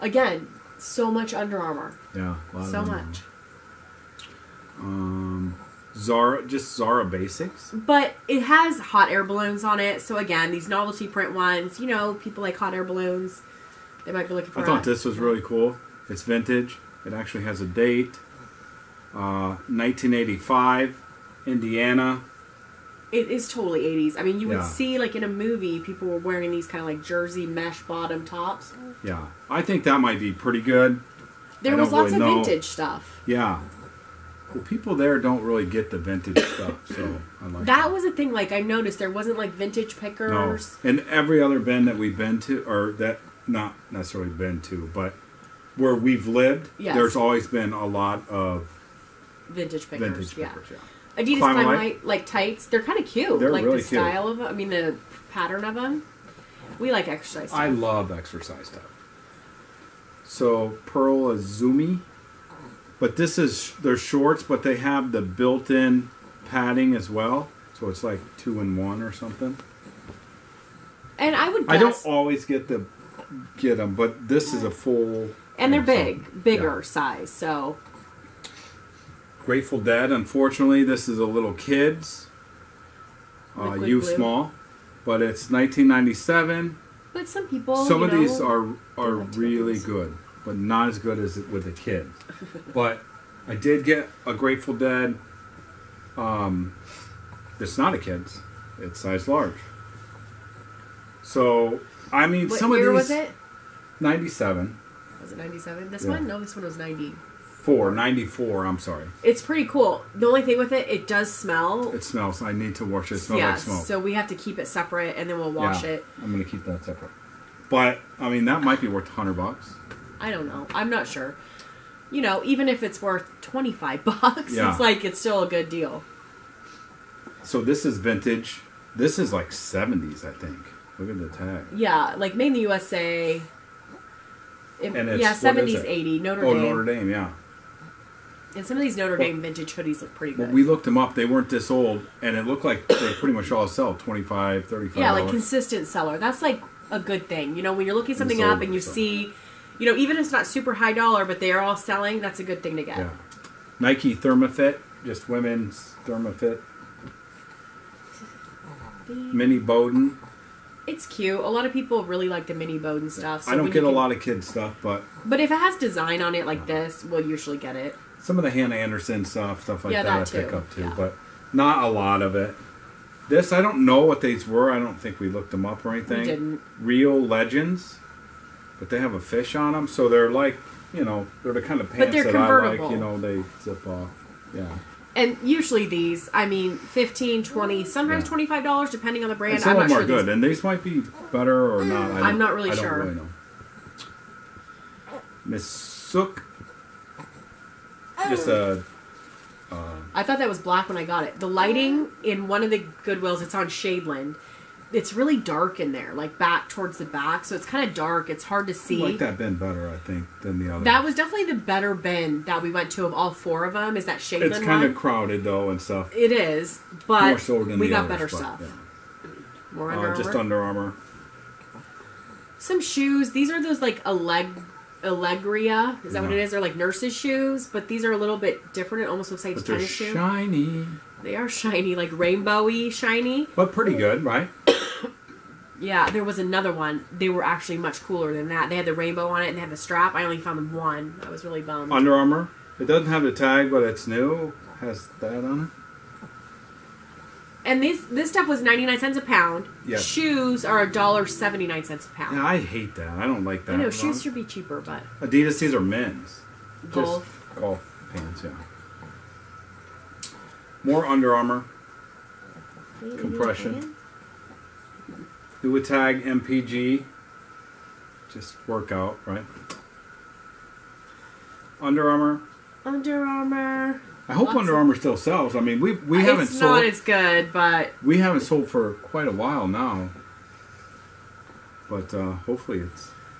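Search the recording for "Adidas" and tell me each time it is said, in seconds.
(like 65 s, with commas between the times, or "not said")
51 s, 255 s.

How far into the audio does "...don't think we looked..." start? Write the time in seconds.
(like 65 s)
174 s.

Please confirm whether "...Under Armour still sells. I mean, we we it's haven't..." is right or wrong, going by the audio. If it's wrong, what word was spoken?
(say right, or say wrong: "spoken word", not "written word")
right.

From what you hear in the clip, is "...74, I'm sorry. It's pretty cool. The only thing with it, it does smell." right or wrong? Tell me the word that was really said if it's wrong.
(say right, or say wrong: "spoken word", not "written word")
wrong: "94", not "74".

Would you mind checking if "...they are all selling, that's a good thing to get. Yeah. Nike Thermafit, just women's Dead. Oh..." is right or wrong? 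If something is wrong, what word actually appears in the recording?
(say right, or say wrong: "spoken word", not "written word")
wrong: "Thermafit", not "Dead".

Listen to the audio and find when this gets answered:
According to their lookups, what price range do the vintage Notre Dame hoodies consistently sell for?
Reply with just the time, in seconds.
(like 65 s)
143 s.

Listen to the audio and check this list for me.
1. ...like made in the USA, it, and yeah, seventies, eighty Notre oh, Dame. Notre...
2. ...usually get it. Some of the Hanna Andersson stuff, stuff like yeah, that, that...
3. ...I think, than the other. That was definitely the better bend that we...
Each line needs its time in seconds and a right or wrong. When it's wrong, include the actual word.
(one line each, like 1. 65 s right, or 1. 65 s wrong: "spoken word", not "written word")
1. 132 s right
2. 167 s right
3. 209 s right.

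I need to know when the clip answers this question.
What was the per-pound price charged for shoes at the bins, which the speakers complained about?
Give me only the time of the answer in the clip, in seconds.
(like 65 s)
250 s.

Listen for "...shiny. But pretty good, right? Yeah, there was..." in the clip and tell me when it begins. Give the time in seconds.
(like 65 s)
232 s.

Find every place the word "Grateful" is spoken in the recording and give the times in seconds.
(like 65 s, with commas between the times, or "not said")
79 s, 94 s.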